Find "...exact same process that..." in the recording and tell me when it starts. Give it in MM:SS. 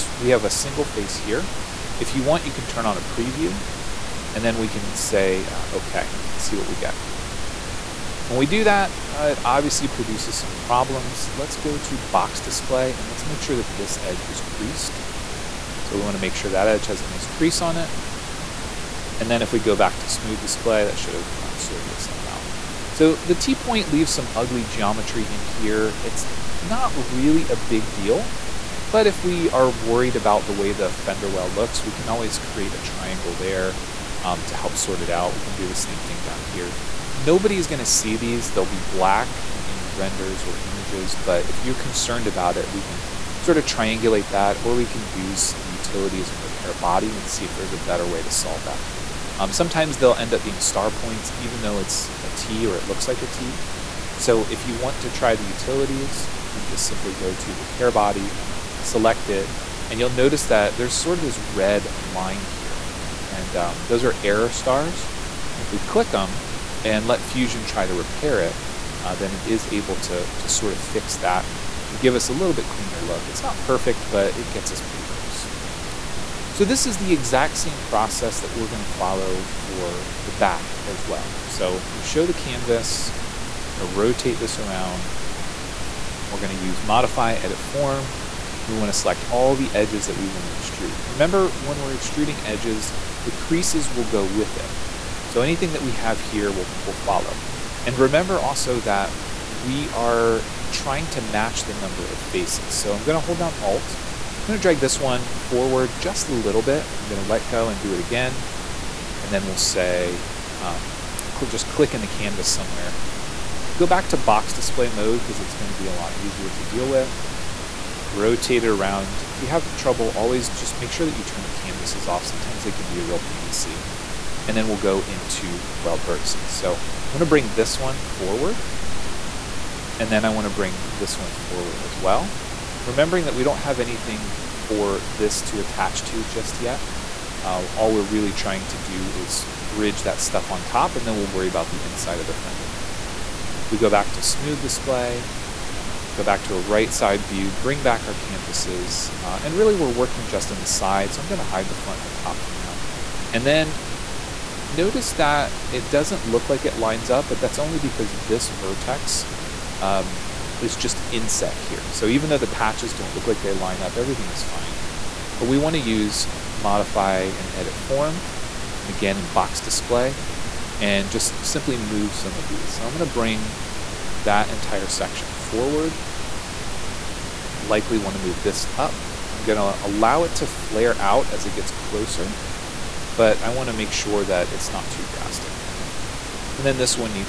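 01:17.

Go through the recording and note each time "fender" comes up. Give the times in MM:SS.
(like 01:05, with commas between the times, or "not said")
00:30, 02:22.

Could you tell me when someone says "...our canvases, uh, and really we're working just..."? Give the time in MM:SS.
02:28.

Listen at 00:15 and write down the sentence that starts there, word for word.
So we wanna make sure that edge has a nice crease on it.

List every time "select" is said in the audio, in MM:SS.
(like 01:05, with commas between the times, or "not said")
00:58, 01:28.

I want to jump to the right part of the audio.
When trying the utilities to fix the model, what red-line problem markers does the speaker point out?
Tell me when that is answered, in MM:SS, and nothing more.
01:04.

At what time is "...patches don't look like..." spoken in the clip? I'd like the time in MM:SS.
02:42.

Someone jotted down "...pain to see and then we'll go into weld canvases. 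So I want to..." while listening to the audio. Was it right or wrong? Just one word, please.
wrong.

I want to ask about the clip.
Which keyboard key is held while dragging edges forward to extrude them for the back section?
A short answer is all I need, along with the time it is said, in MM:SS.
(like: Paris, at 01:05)
Alt, at 01:43.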